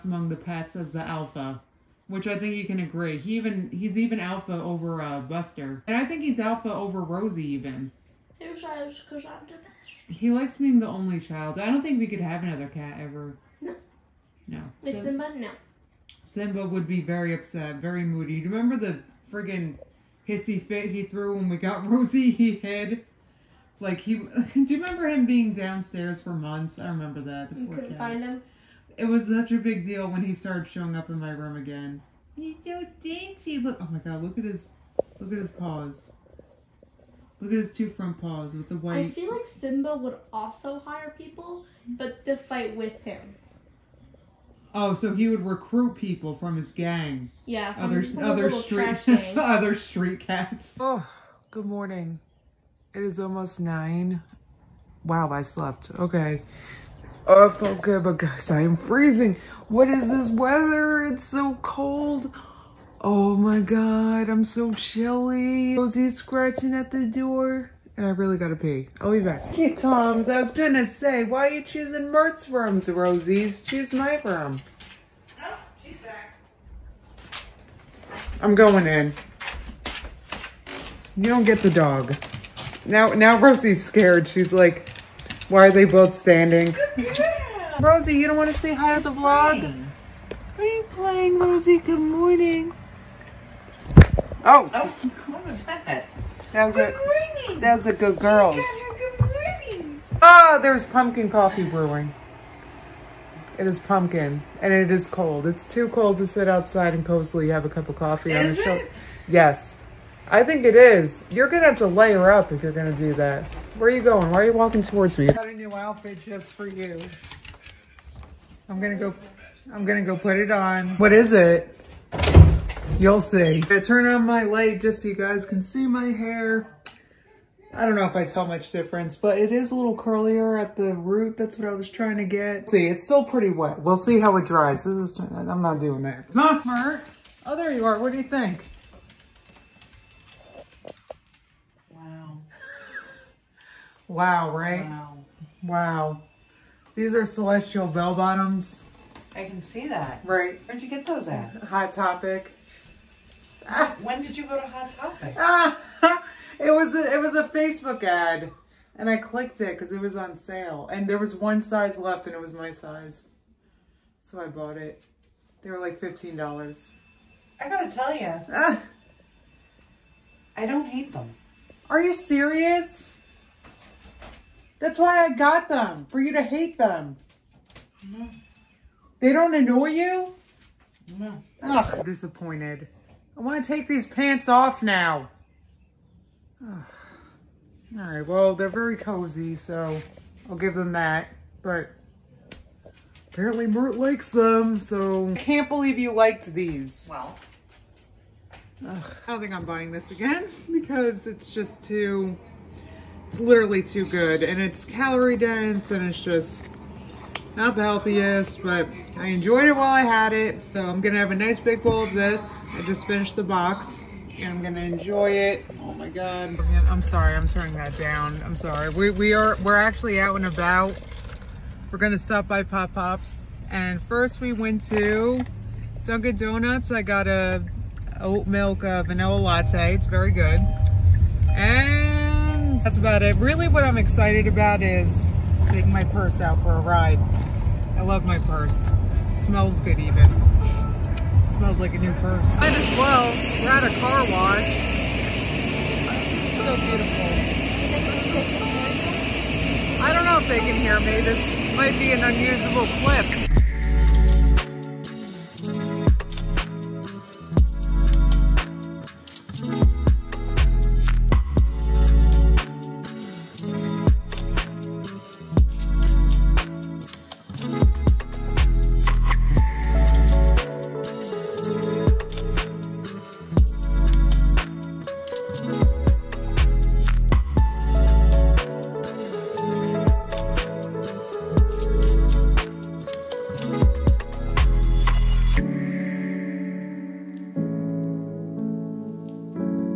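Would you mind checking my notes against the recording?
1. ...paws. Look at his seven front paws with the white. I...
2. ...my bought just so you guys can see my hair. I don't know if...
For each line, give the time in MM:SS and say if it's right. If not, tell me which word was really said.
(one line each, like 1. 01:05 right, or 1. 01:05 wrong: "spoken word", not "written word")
1. 00:35 wrong: "two", not "seven"
2. 02:04 wrong: "light", not "bought".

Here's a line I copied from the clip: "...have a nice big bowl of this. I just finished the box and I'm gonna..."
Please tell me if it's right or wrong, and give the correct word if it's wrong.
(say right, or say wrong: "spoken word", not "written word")
right.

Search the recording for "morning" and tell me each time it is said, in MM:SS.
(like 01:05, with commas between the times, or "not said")
00:51, 01:31, 01:36.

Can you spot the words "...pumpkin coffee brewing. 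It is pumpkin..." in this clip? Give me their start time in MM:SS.
01:40.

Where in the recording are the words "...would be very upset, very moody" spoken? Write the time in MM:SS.
00:16.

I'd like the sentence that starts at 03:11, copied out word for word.
But apparently Mert likes them, so...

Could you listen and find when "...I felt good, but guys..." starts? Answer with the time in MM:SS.
00:57.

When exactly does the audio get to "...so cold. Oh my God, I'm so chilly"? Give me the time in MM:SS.
01:01.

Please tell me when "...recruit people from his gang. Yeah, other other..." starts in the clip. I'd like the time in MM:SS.
00:45.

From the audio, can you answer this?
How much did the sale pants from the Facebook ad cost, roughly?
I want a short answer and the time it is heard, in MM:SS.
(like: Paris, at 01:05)
$15, at 02:45.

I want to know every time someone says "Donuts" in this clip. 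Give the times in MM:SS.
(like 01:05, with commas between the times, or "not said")
03:46.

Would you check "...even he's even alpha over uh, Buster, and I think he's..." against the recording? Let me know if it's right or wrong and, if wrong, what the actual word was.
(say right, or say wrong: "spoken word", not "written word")
right.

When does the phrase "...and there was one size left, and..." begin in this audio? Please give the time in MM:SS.
02:40.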